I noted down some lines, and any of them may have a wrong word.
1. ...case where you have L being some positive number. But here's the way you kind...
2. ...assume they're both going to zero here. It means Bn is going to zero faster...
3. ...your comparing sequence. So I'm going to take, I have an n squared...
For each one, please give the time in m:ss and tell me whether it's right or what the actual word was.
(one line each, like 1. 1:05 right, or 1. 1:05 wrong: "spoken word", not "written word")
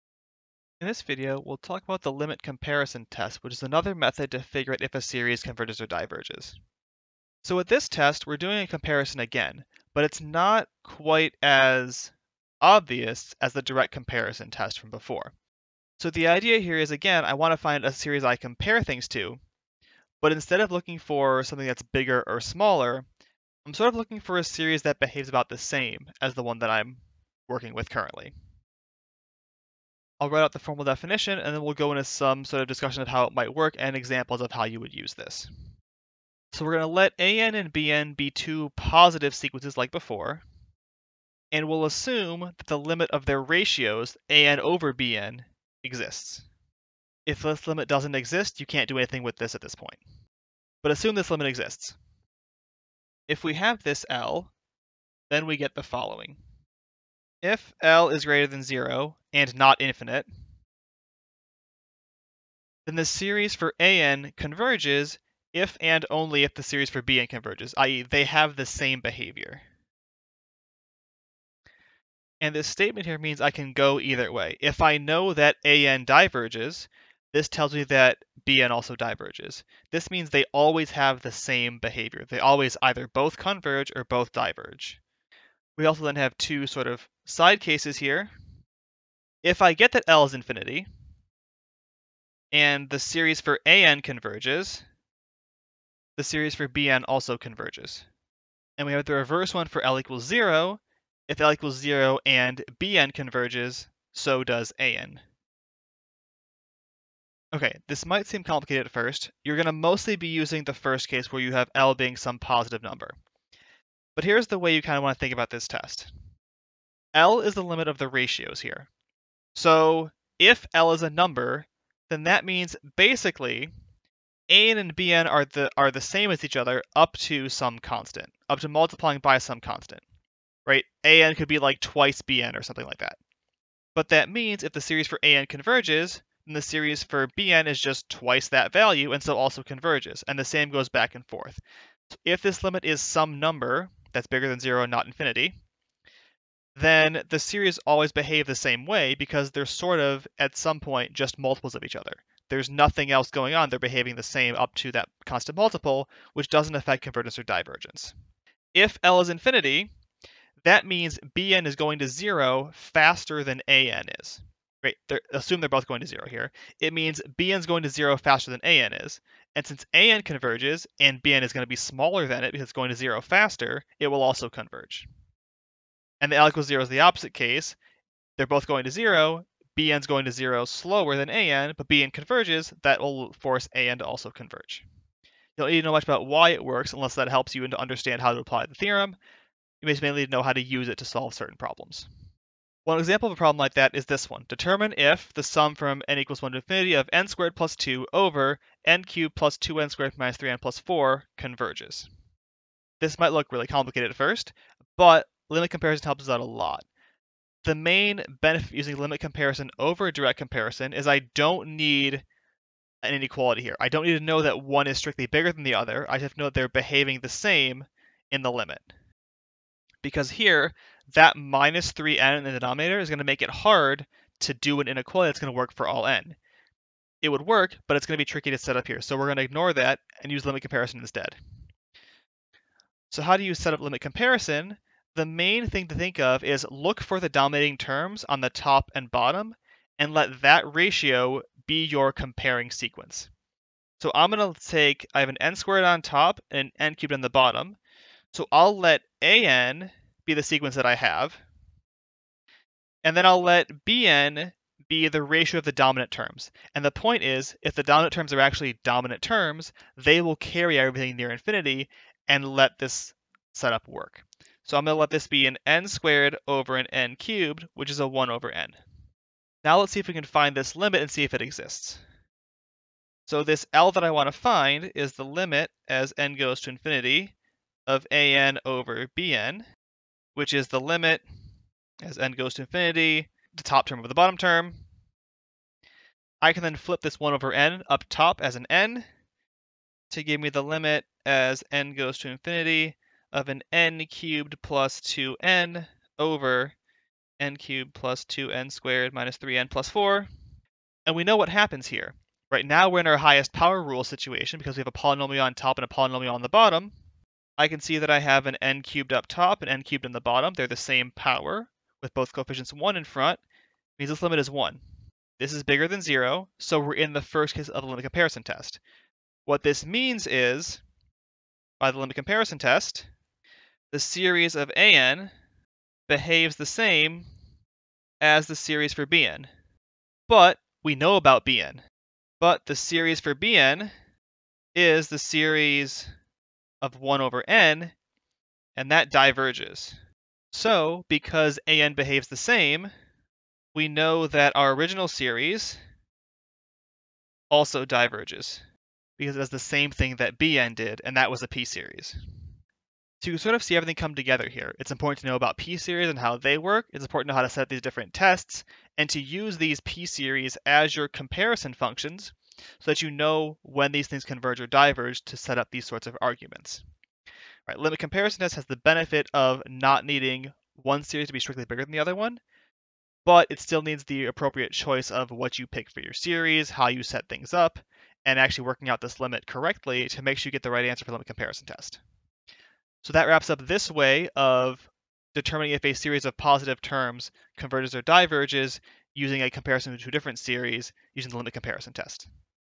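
1. 1:51 right
2. 2:45 right
3. 4:01 right.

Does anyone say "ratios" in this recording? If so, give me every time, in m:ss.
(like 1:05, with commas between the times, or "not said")
0:43, 1:58, 4:00, 4:15.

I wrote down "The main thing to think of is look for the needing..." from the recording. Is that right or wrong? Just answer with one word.
wrong.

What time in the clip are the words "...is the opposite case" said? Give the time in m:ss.
2:56.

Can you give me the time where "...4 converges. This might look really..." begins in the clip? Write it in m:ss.
3:20.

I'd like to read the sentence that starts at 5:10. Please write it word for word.
They're the same power with both coefficients 1 in front.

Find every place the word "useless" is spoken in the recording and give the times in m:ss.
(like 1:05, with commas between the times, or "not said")
not said.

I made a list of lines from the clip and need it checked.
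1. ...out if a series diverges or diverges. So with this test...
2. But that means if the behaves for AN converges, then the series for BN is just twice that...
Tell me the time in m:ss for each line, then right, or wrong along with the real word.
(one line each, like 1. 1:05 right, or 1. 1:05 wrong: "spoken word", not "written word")
1. 0:04 wrong: "converges", not "diverges"
2. 2:13 wrong: "series", not "behaves".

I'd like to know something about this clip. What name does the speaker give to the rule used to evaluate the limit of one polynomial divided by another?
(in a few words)
highest power rule.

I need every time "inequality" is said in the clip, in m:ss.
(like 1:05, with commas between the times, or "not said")
3:33, 3:44.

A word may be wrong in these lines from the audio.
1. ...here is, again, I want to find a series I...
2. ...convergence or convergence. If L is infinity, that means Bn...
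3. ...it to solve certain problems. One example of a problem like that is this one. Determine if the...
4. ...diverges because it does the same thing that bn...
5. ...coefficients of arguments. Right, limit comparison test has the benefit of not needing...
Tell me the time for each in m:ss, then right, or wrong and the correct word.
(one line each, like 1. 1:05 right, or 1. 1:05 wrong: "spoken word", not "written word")
1. 0:16 right
2. 2:37 wrong: "divergence", not "convergence"
3. 3:10 right
4. 5:47 right
5. 6:05 wrong: "sorts", not "coefficients".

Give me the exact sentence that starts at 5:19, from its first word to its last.
What this means is, by the limit comparison test, the series of an behaves the same as the series for bn.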